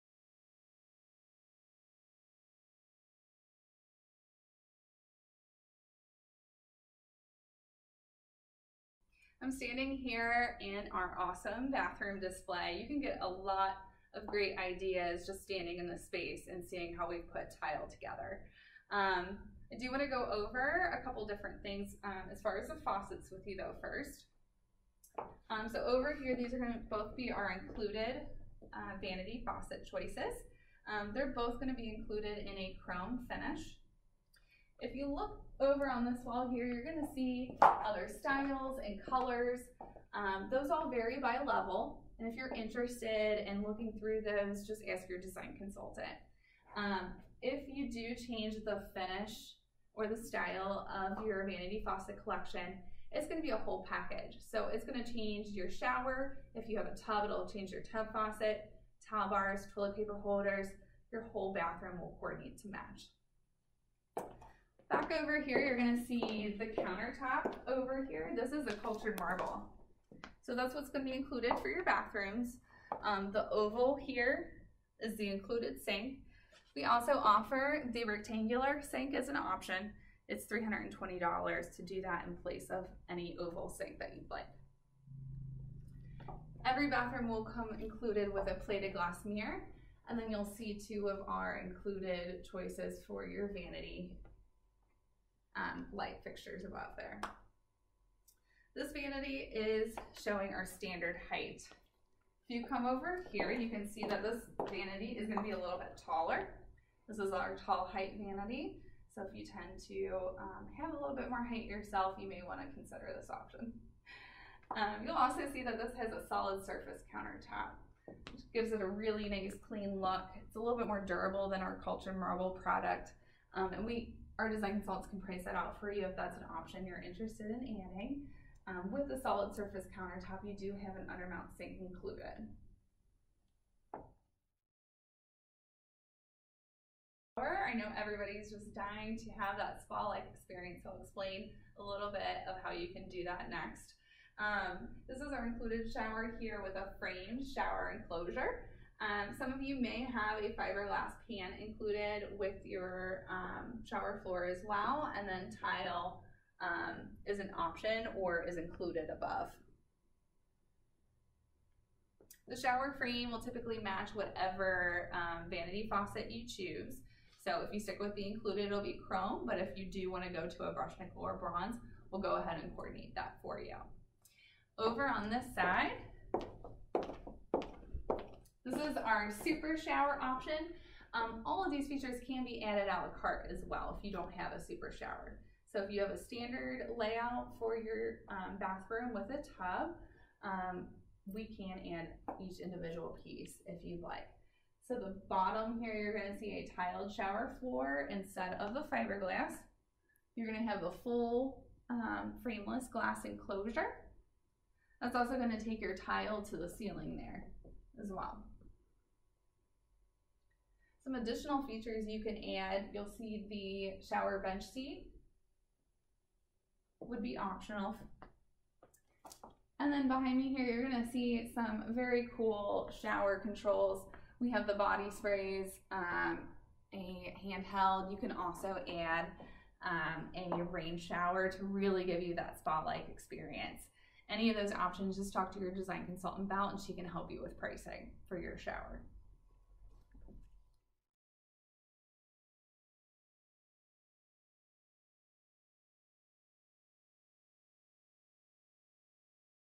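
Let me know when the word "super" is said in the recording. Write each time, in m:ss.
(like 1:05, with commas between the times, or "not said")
2:59, 3:04.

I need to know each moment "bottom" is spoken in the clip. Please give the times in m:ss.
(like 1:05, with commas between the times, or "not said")
3:15.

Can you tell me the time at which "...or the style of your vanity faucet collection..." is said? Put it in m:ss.
0:49.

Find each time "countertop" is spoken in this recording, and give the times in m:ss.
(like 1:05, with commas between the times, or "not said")
1:06, 1:57, 2:09.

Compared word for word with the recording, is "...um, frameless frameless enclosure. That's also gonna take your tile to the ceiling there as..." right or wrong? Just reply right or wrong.
wrong.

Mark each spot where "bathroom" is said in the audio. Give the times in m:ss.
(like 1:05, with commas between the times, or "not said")
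0:11, 1:01, 1:11, 1:26, 3:08.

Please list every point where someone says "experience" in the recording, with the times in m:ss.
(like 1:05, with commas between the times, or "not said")
2:20, 3:53.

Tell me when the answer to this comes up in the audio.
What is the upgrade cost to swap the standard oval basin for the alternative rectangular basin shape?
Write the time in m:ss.
1:20.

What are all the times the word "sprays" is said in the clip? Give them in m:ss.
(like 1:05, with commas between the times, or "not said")
3:45.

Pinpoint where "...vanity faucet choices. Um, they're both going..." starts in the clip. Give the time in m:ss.
0:29.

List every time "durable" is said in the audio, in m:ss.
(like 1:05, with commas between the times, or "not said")
2:01.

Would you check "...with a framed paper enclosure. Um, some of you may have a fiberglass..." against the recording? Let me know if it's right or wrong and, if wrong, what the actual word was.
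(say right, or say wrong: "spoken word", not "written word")
wrong: "shower", not "paper".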